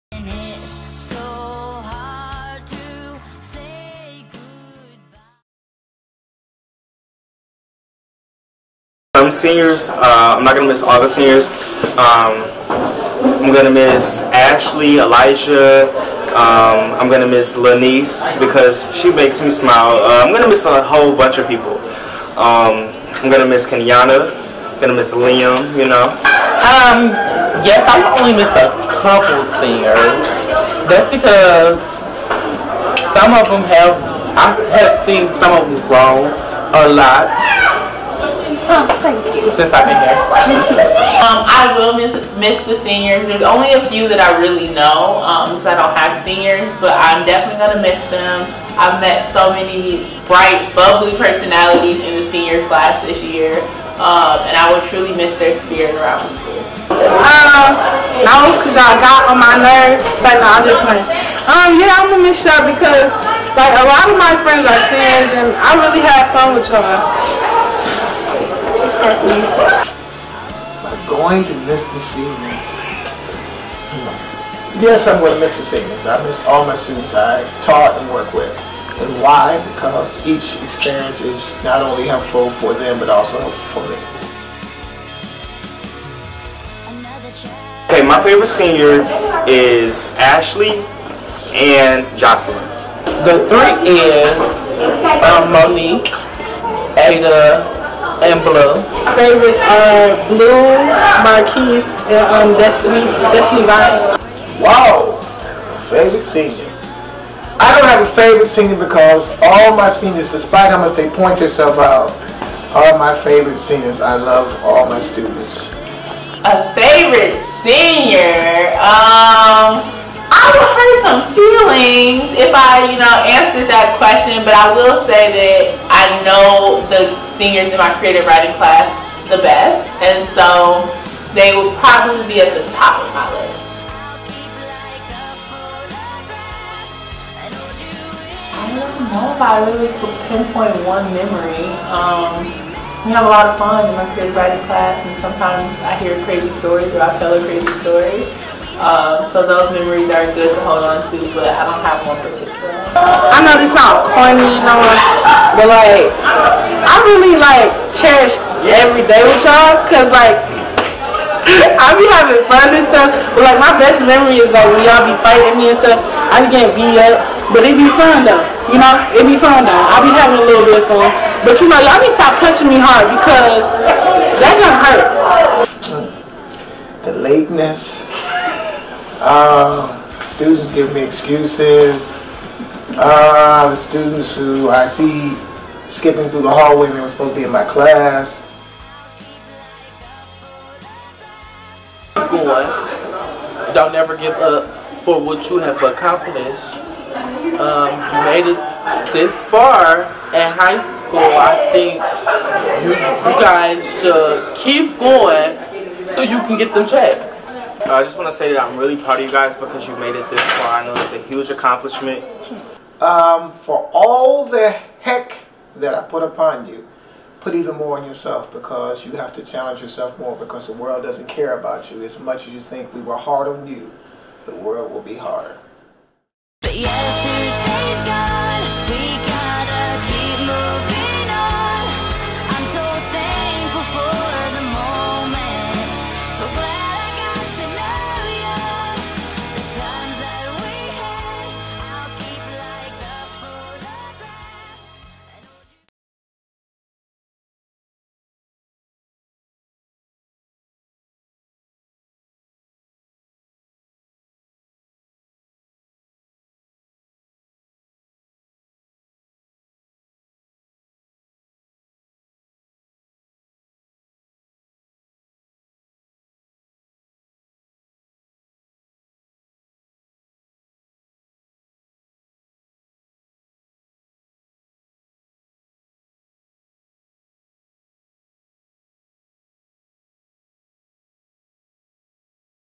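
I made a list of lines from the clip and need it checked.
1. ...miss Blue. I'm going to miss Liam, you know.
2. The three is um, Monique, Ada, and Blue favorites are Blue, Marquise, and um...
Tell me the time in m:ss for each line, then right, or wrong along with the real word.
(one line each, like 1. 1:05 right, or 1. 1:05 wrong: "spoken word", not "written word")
1. 0:23 wrong: "Kenyana", not "Blue"
2. 1:33 right.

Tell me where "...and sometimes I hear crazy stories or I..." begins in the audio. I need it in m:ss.
2:24.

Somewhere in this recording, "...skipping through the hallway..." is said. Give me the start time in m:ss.
3:05.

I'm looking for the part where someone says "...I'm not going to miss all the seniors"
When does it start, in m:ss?
0:10.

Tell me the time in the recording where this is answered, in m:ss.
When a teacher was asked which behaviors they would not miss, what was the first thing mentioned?
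2:57.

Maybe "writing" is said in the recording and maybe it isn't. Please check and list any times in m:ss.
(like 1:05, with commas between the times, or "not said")
2:08, 2:24.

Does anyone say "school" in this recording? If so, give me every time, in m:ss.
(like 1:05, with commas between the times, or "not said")
0:56, 3:20.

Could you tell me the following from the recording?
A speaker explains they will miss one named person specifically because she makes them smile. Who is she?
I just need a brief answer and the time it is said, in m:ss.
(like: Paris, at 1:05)
Lanice, at 0:17.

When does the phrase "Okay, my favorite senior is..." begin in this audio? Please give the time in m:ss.
1:27.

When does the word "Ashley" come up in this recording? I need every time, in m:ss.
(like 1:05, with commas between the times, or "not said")
0:14, 1:30.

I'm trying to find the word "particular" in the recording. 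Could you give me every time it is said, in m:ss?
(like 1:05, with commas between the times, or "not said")
2:32.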